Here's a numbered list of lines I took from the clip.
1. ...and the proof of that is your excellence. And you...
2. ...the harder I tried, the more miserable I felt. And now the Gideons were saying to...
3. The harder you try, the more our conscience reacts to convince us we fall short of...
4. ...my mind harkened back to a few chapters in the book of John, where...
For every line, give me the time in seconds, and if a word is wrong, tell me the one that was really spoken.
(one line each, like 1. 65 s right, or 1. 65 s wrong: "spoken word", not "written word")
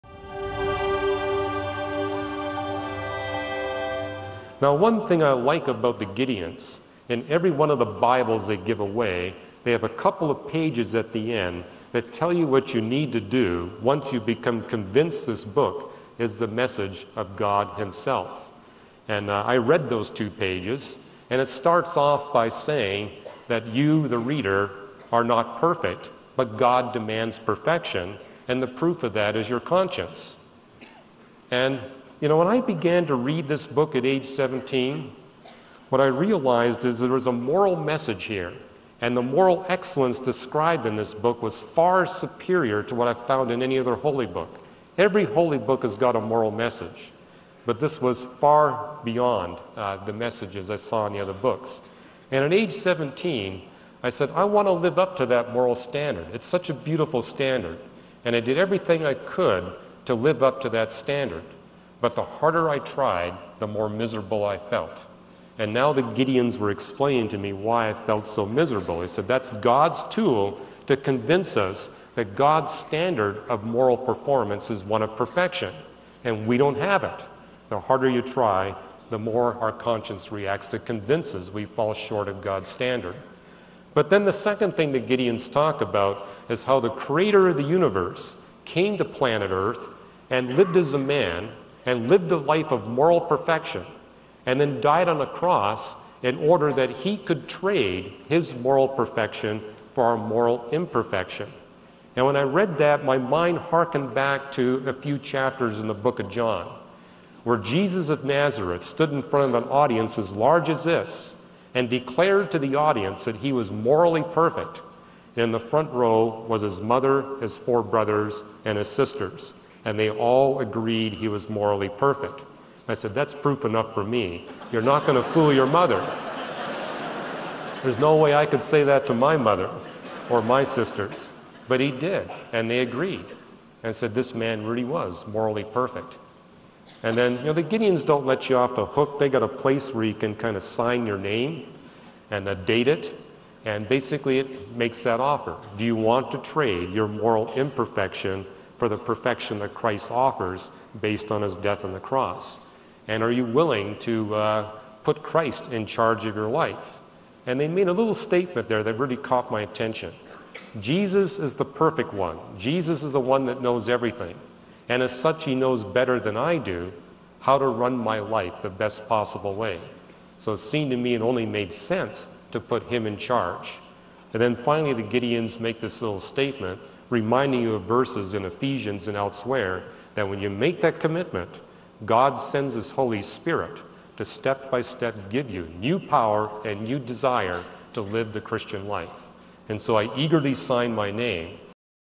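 1. 28 s wrong: "conscience", not "excellence"
2. 62 s wrong: "explaining", not "saying"
3. 77 s right
4. 103 s right.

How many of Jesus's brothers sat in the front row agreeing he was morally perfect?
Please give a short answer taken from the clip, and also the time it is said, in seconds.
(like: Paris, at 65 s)
4, at 117 s.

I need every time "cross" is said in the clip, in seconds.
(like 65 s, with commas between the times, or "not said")
95 s, 151 s.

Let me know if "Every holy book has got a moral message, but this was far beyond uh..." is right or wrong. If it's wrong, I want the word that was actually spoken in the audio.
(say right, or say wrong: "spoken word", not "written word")
right.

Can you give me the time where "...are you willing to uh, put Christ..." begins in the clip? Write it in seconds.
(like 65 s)
153 s.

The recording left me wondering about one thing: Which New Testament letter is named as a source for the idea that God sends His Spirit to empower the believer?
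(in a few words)
Ephesians.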